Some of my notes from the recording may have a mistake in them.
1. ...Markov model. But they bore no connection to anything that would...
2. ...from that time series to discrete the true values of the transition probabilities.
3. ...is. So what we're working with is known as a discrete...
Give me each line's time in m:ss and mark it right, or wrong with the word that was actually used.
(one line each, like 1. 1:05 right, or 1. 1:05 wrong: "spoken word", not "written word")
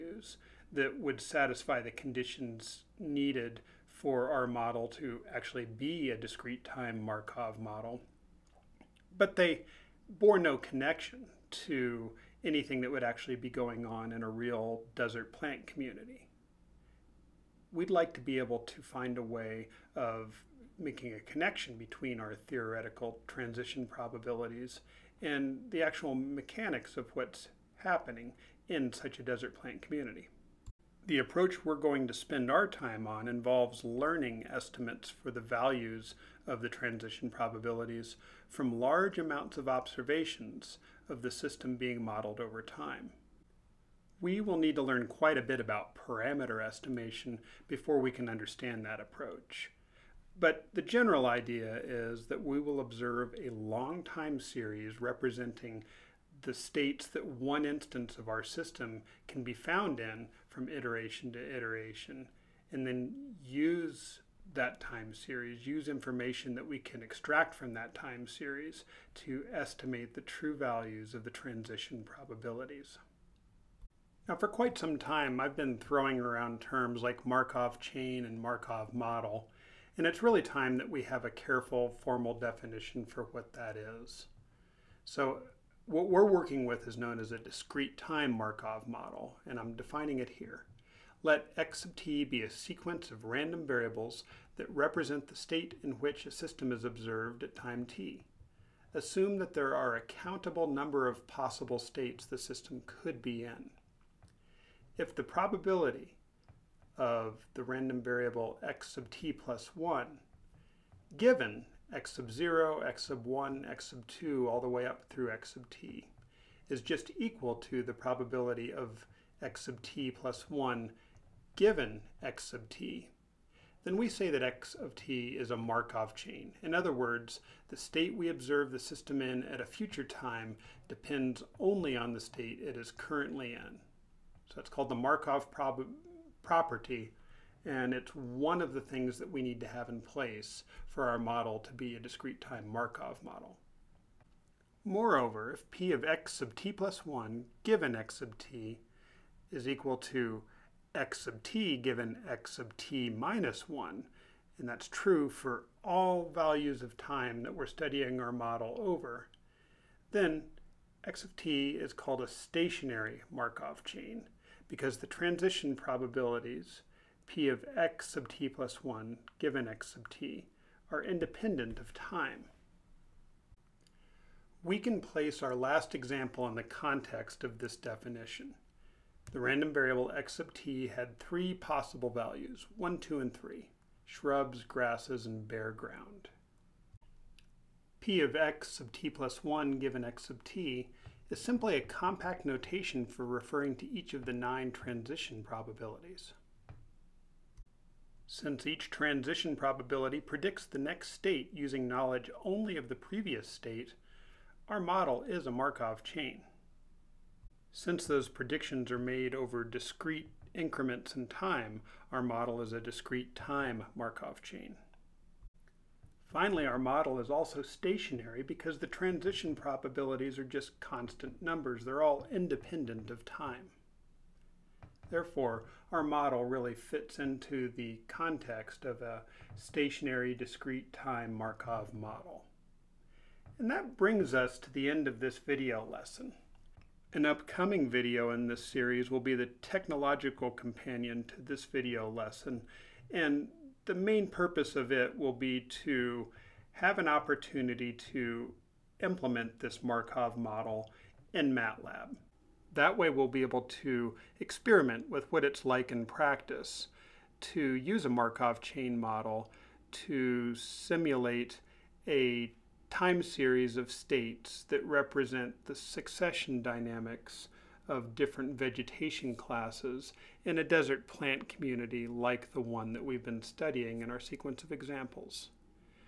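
1. 0:07 right
2. 1:07 wrong: "estimate", not "discrete"
3. 1:23 right.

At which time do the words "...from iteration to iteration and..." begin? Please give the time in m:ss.
1:00.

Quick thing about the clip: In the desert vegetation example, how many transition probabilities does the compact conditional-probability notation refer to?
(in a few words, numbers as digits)
9.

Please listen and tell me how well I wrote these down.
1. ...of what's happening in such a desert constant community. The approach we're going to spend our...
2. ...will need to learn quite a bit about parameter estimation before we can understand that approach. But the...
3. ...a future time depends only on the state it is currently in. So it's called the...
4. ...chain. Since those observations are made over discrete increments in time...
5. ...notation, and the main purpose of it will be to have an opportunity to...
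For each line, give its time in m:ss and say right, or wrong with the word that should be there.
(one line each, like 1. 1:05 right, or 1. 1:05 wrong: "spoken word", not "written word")
1. 0:26 wrong: "plant", not "constant"
2. 0:44 right
3. 2:09 right
4. 3:26 wrong: "predictions", not "observations"
5. 4:02 wrong: "lesson", not "notation".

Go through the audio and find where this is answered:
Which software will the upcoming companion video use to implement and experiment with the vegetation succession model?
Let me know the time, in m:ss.
4:11.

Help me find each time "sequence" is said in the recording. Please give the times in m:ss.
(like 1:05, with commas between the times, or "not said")
1:32, 4:34.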